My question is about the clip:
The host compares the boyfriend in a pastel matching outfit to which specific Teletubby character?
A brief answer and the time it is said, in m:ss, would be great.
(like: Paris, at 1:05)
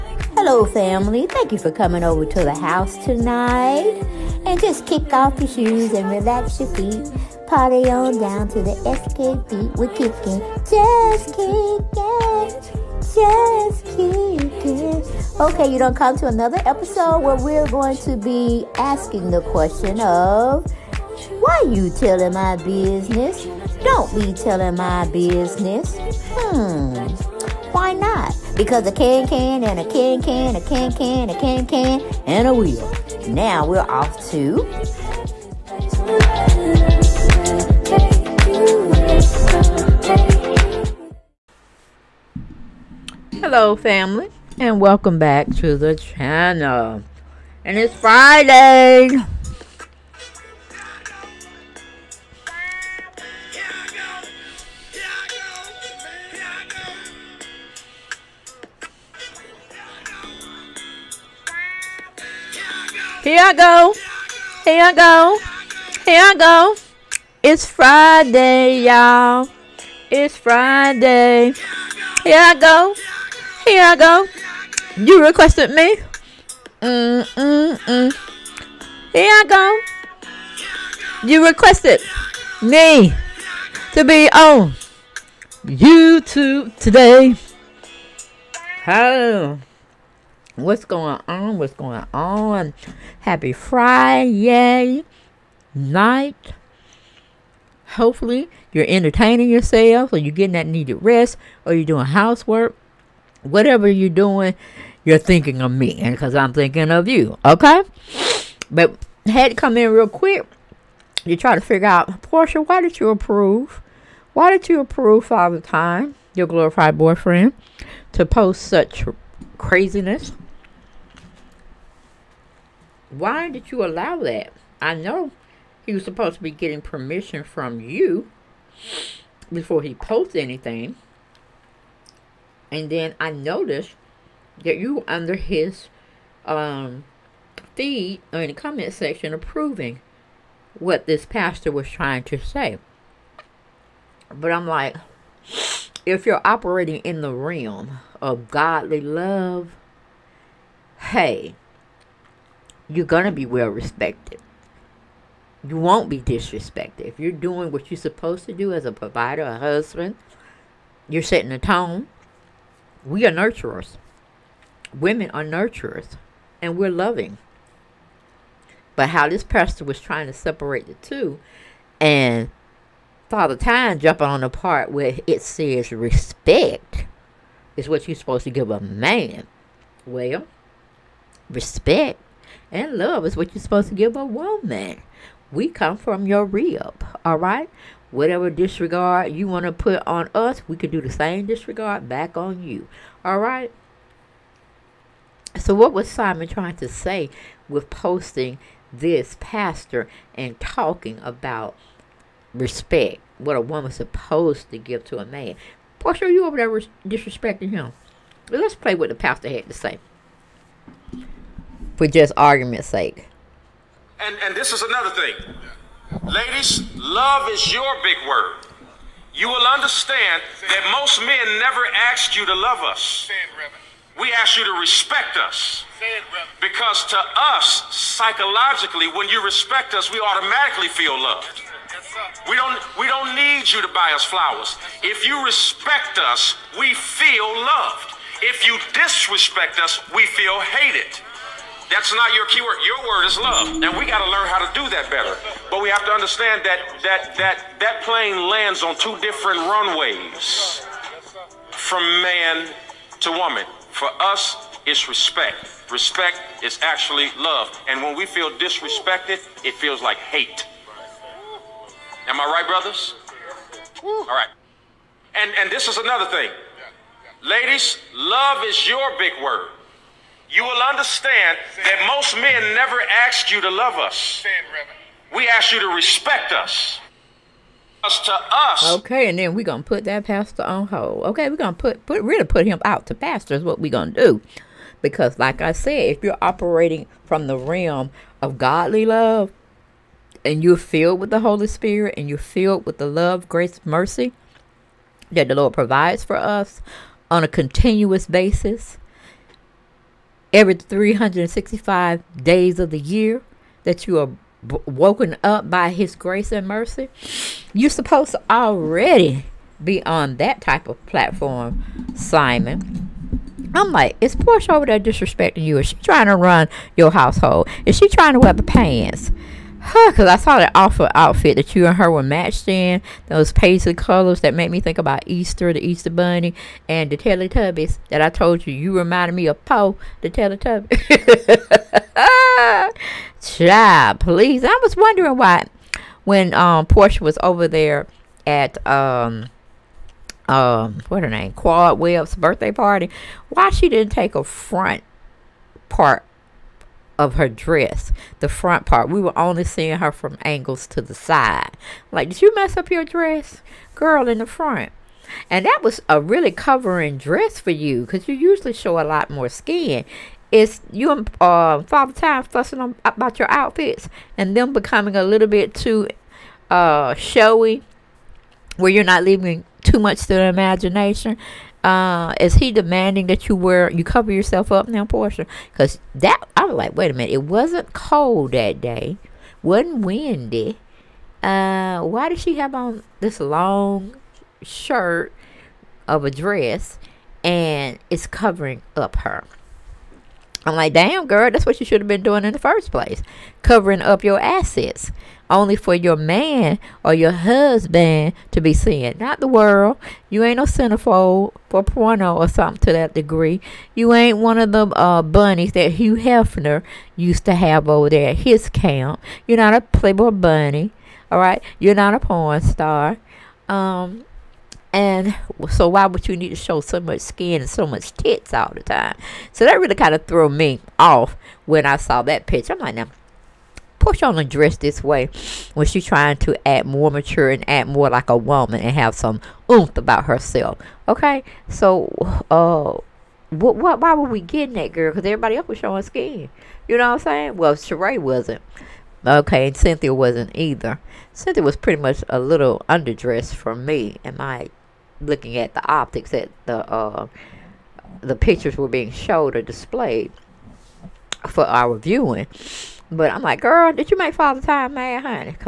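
Po, at 5:29.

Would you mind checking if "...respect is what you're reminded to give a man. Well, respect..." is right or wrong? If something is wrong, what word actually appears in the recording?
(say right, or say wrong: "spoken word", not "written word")
wrong: "supposed", not "reminded".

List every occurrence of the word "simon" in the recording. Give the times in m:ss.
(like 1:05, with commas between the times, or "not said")
3:16, 5:12.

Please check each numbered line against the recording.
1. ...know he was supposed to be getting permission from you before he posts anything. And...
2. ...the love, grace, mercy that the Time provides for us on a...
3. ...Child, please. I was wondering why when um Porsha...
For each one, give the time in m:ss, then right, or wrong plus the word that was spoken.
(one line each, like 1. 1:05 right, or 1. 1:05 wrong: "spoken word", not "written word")
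1. 2:04 right
2. 4:52 wrong: "Lord", not "Time"
3. 5:33 right.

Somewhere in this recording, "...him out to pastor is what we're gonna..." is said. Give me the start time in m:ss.
4:42.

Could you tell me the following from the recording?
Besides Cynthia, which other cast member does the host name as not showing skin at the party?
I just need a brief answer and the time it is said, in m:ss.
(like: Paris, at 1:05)
Sheree, at 7:17.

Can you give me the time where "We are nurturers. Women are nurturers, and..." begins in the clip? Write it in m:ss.
2:43.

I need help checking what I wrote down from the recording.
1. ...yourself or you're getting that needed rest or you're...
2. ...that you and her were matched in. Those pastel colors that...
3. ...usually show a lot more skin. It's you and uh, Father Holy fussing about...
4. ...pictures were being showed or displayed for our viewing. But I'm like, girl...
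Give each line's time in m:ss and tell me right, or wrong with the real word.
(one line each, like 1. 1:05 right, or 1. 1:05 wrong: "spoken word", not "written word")
1. 1:39 right
2. 5:21 right
3. 5:58 wrong: "Time", not "Holy"
4. 7:28 right.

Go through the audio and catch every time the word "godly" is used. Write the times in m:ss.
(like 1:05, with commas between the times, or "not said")
2:28, 4:48.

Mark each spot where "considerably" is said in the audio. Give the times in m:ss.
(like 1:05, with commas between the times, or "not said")
not said.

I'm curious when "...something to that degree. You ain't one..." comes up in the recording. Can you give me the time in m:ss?
6:42.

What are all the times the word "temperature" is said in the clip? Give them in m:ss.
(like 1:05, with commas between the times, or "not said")
not said.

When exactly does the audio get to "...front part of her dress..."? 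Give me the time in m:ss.
5:44.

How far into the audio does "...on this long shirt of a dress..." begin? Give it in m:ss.
6:22.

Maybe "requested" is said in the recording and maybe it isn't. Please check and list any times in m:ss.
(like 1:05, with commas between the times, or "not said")
1:15, 1:21.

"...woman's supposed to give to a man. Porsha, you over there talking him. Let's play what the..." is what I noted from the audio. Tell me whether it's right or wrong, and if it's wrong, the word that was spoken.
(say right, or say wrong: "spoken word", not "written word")
wrong: "disrespecting", not "talking".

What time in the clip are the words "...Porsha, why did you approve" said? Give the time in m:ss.
1:52.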